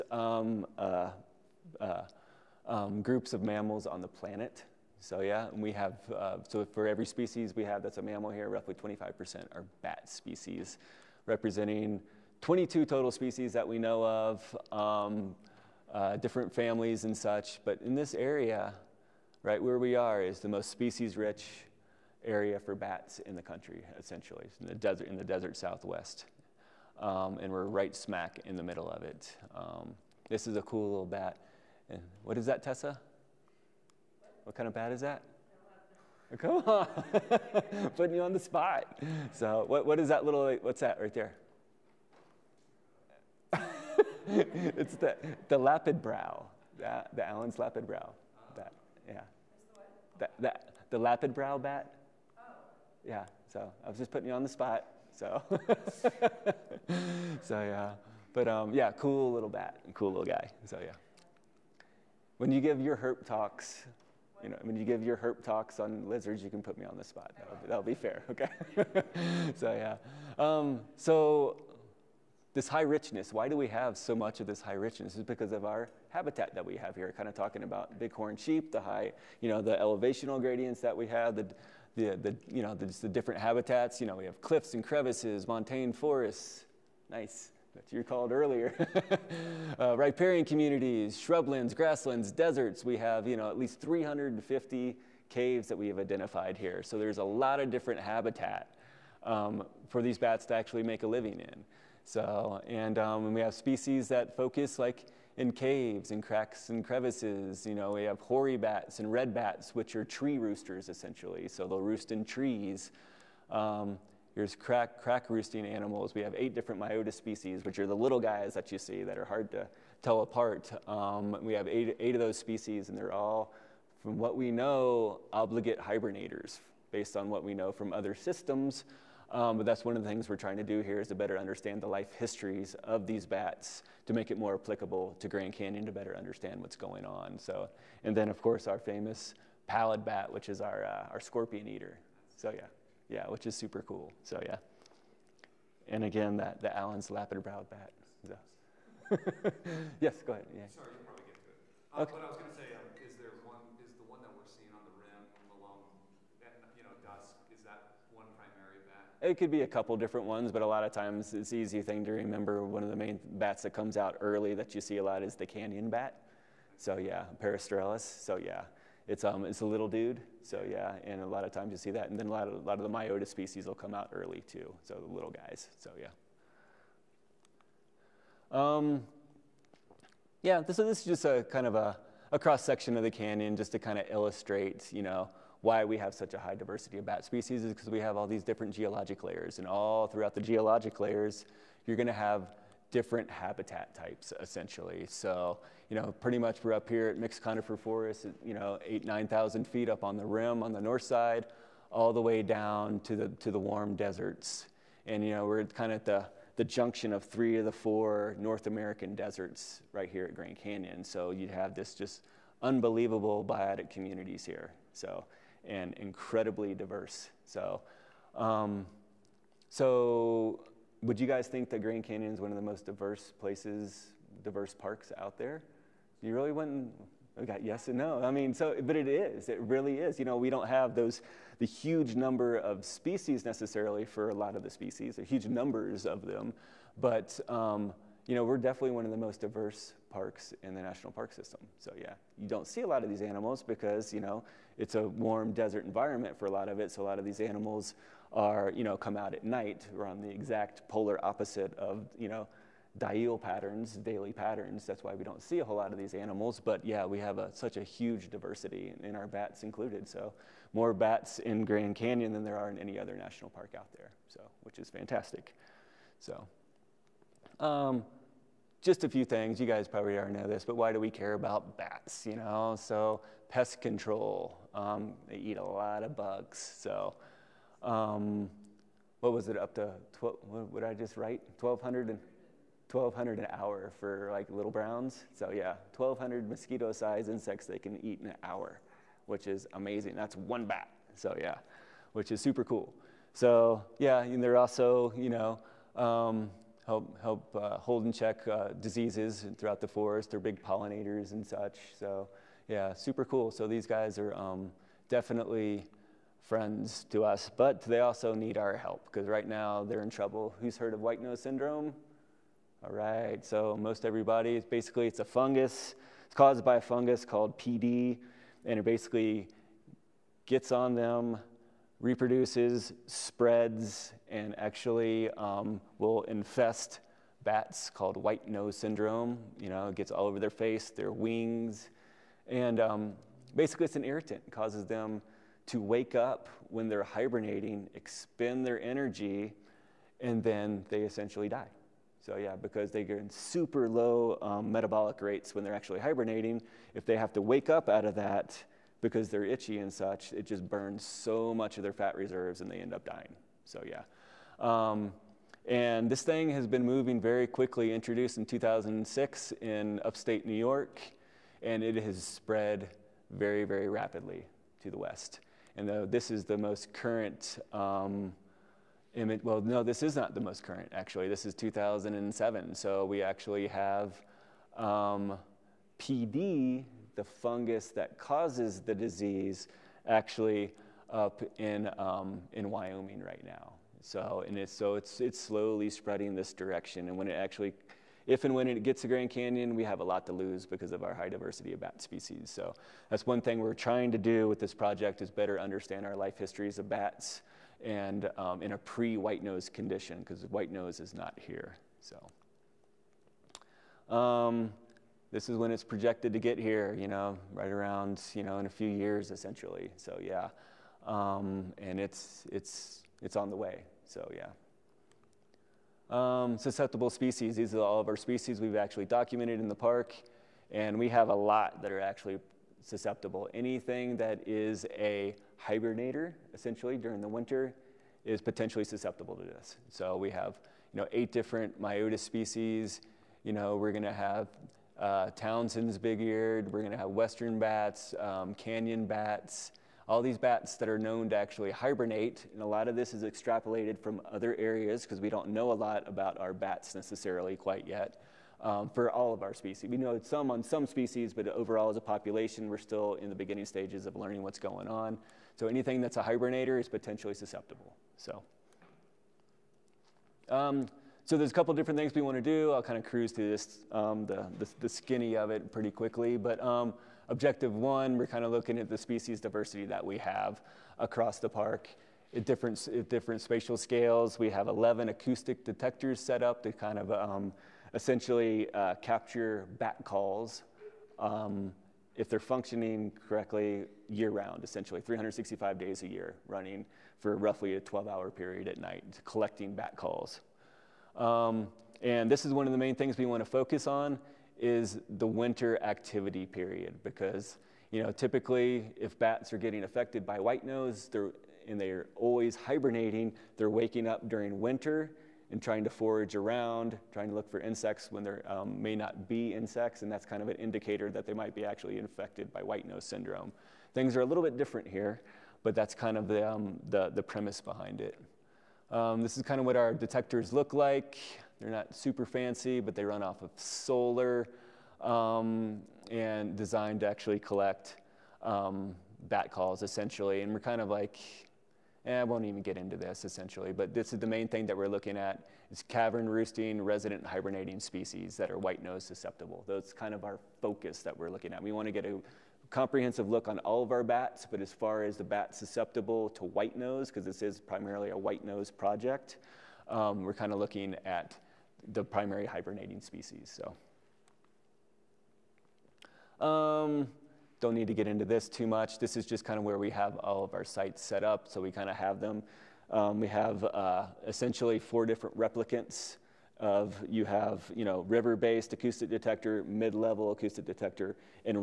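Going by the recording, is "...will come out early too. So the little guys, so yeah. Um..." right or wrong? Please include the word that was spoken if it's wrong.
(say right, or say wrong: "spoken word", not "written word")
right.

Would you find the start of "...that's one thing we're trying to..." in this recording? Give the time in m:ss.
6:33.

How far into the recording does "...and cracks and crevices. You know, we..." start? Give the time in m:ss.
1:46.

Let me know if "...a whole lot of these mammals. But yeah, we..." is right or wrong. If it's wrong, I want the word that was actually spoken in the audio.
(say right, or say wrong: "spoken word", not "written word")
wrong: "animals", not "mammals".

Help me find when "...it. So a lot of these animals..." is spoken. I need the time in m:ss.
4:06.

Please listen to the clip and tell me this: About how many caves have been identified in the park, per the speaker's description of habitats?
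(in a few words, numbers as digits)
350.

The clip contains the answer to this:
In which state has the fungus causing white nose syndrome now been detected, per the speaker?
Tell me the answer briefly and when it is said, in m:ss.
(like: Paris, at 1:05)
Wyoming, at 6:22.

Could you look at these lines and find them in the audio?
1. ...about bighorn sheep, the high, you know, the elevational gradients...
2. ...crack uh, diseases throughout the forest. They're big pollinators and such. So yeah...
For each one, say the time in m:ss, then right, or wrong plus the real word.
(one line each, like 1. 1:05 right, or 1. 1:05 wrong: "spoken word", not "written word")
1. 1:17 right
2. 4:58 wrong: "check", not "crack".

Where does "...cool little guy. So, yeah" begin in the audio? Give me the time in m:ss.
0:59.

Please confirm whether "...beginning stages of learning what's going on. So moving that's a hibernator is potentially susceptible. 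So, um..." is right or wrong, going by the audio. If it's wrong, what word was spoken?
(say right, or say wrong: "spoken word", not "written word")
wrong: "anything", not "moving".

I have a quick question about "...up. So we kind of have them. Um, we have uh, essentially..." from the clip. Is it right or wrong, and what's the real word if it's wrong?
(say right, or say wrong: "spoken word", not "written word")
right.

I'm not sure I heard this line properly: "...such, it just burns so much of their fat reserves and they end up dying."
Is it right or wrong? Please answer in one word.
right.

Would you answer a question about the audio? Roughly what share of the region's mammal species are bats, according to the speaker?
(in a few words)
25%.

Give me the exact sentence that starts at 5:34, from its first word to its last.
It causes them to wake up when they're hibernating, expend their energy, and then they essentially die.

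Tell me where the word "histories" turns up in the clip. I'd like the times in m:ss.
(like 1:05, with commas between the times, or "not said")
2:12, 6:36.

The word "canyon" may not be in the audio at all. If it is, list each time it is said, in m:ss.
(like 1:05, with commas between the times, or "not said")
2:15, 2:45, 3:03, 3:30, 3:42, 4:21, 6:29, 7:18.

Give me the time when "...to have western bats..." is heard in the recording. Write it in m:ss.
7:16.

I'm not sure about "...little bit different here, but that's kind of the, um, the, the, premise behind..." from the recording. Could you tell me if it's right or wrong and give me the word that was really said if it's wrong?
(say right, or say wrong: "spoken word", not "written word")
right.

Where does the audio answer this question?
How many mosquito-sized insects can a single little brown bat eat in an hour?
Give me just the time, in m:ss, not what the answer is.
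4:45.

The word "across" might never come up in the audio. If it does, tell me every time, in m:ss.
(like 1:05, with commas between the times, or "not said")
7:50.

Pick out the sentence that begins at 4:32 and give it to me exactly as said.
So pest control, um, they eat a lot of bugs.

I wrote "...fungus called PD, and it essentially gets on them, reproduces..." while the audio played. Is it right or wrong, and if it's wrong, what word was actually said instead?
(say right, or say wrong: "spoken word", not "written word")
wrong: "basically", not "essentially".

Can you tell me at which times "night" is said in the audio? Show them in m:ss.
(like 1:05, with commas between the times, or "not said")
4:09, 8:08.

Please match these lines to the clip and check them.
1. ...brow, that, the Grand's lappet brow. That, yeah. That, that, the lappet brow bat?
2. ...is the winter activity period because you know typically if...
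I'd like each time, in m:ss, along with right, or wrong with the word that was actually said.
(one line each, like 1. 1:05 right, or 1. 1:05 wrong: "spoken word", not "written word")
1. 0:46 wrong: "Allen", not "Grand"
2. 8:14 right.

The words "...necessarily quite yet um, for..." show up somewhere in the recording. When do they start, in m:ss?
7:26.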